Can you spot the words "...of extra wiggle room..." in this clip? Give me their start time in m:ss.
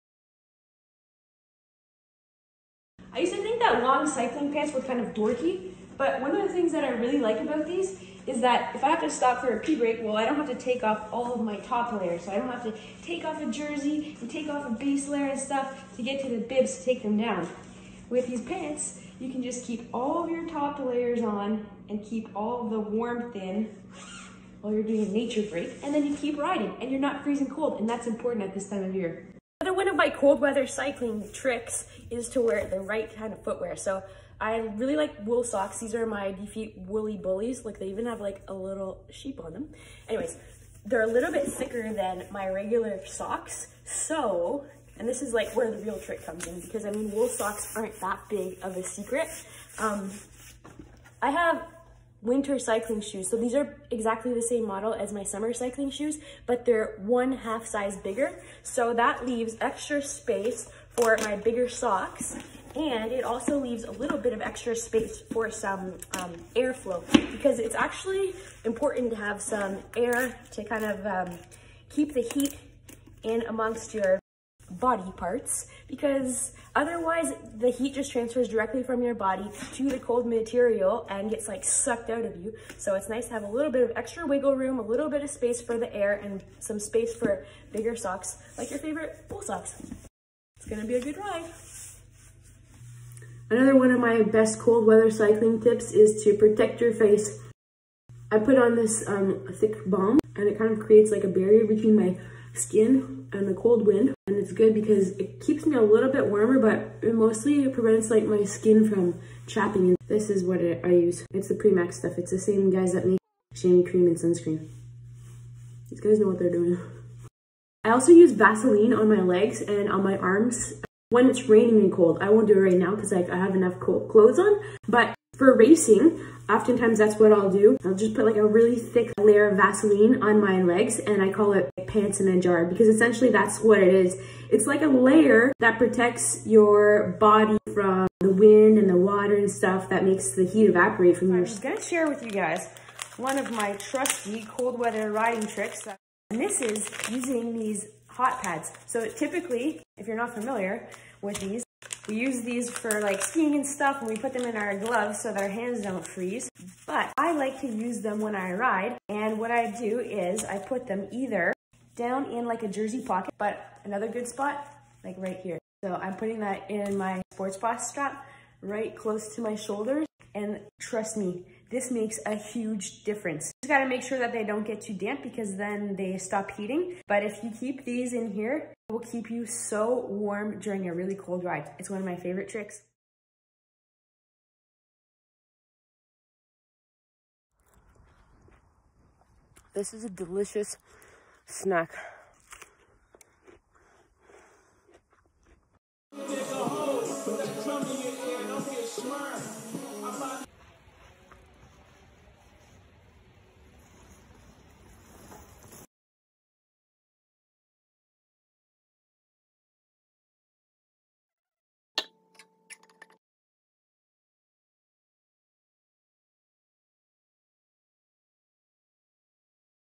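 1:23.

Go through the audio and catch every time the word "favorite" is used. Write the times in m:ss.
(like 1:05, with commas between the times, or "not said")
1:28, 3:02.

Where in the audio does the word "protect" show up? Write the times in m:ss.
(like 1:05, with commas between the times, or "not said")
1:36, 2:15.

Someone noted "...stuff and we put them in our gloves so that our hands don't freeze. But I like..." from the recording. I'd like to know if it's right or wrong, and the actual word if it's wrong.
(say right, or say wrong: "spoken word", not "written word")
right.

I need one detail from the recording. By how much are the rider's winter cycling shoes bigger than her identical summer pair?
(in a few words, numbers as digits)
one half size.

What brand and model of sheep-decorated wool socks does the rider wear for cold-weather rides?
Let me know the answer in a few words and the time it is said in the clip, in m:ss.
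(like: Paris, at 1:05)
DeFeet Woolie Boolies, at 0:36.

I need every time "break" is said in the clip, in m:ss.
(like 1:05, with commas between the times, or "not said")
0:09, 0:25.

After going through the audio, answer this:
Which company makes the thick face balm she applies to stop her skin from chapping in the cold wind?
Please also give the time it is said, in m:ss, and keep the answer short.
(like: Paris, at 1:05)
Premax, at 1:51.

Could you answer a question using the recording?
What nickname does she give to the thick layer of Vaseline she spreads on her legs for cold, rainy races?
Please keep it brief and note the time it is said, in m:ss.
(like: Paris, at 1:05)
pants in a jar, at 2:11.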